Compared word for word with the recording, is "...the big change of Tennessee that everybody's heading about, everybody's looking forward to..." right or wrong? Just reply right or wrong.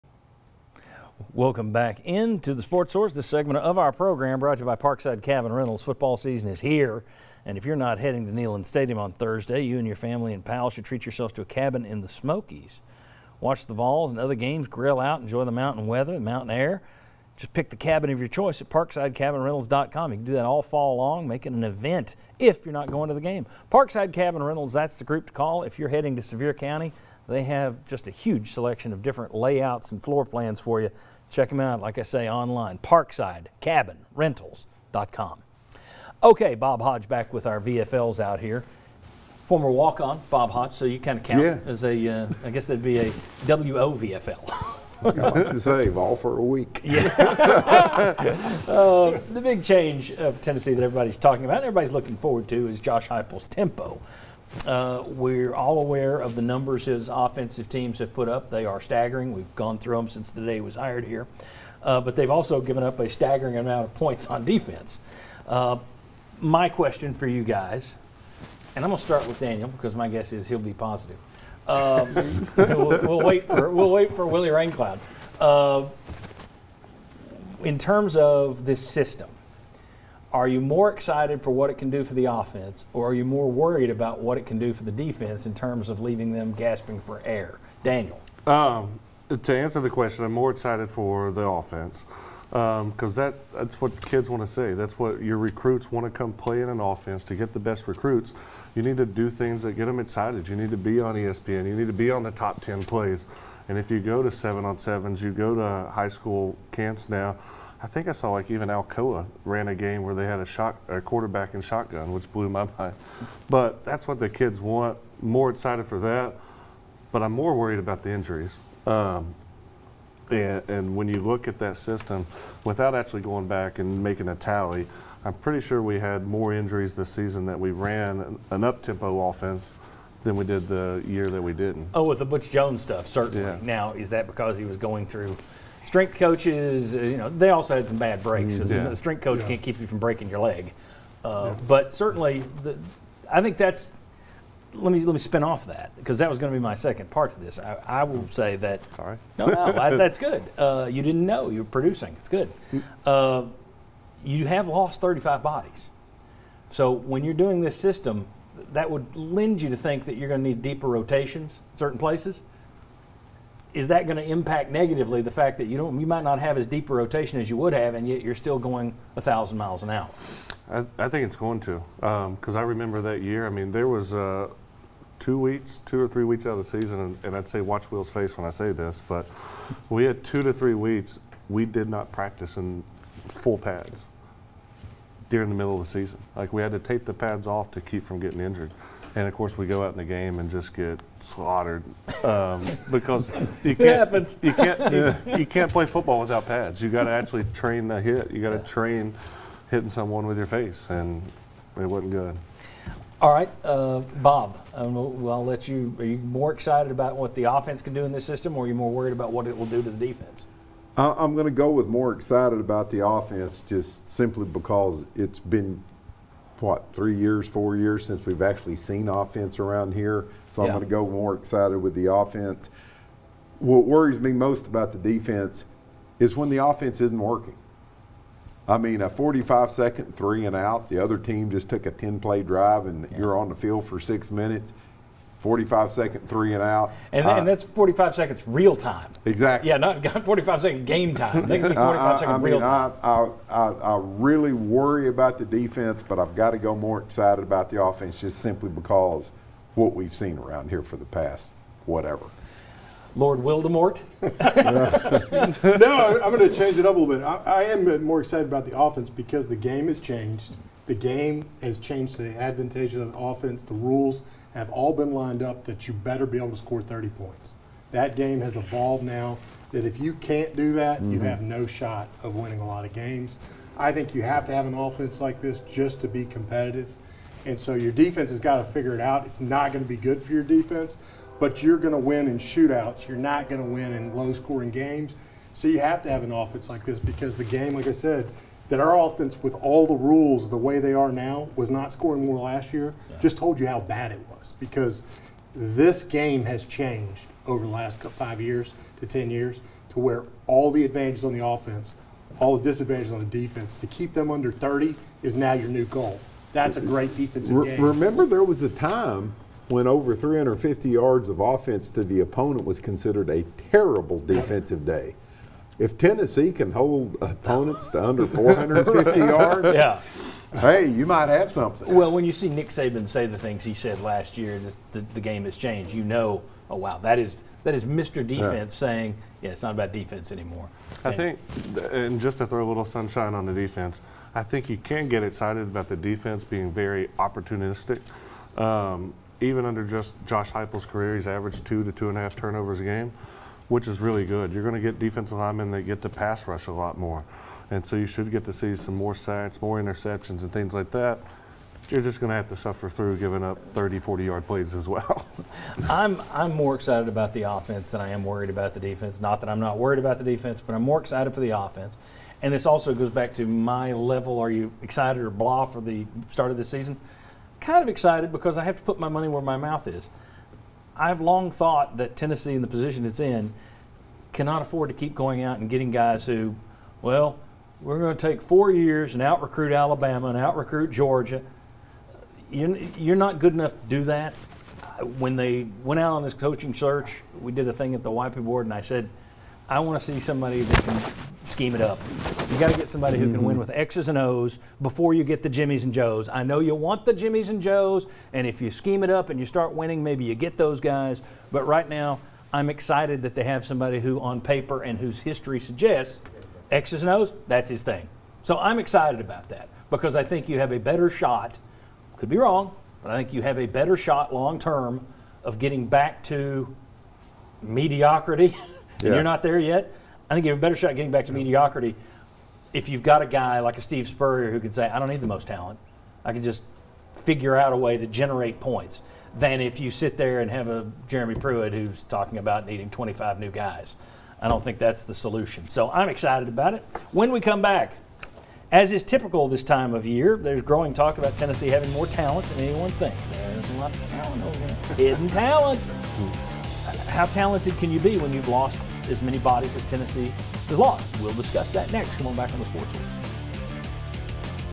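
wrong.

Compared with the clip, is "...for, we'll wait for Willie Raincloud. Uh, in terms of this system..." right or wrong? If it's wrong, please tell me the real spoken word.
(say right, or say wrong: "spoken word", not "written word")
right.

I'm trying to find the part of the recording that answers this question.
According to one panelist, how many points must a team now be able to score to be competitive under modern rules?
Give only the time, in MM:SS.
04:26.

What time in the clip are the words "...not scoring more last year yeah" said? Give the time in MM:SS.
04:51.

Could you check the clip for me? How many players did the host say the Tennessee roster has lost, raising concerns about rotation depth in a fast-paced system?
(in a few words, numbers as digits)
35.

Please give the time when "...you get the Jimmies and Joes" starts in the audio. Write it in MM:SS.
06:35.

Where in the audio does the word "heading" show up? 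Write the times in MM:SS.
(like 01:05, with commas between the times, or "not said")
00:07, 00:25.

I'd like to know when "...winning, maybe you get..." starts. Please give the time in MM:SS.
06:39.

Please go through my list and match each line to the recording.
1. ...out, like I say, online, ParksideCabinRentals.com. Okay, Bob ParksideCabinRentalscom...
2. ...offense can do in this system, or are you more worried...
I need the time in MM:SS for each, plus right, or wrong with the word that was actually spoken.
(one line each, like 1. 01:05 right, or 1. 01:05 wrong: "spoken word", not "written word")
1. 00:31 wrong: "Hodge", not "ParksideCabinRentalscom"
2. 03:27 right.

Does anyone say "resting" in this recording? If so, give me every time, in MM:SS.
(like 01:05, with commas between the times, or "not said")
not said.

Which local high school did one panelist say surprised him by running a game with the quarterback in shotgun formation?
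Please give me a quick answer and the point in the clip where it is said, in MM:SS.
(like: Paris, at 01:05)
Alcoa, at 01:48.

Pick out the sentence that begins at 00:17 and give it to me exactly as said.
Just pick the cabin of your choice at parksidecabinrentals.com.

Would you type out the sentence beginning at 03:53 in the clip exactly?
you're on the field for six minutes.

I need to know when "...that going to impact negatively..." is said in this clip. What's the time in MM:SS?
02:43.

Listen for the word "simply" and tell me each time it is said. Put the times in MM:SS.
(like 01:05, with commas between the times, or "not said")
03:34, 04:08.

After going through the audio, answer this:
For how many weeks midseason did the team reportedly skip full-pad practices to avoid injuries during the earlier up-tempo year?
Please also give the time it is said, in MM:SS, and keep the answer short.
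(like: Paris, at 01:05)
two to three weeks, at 03:00.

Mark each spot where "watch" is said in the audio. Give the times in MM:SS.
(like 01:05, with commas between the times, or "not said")
00:13, 02:57.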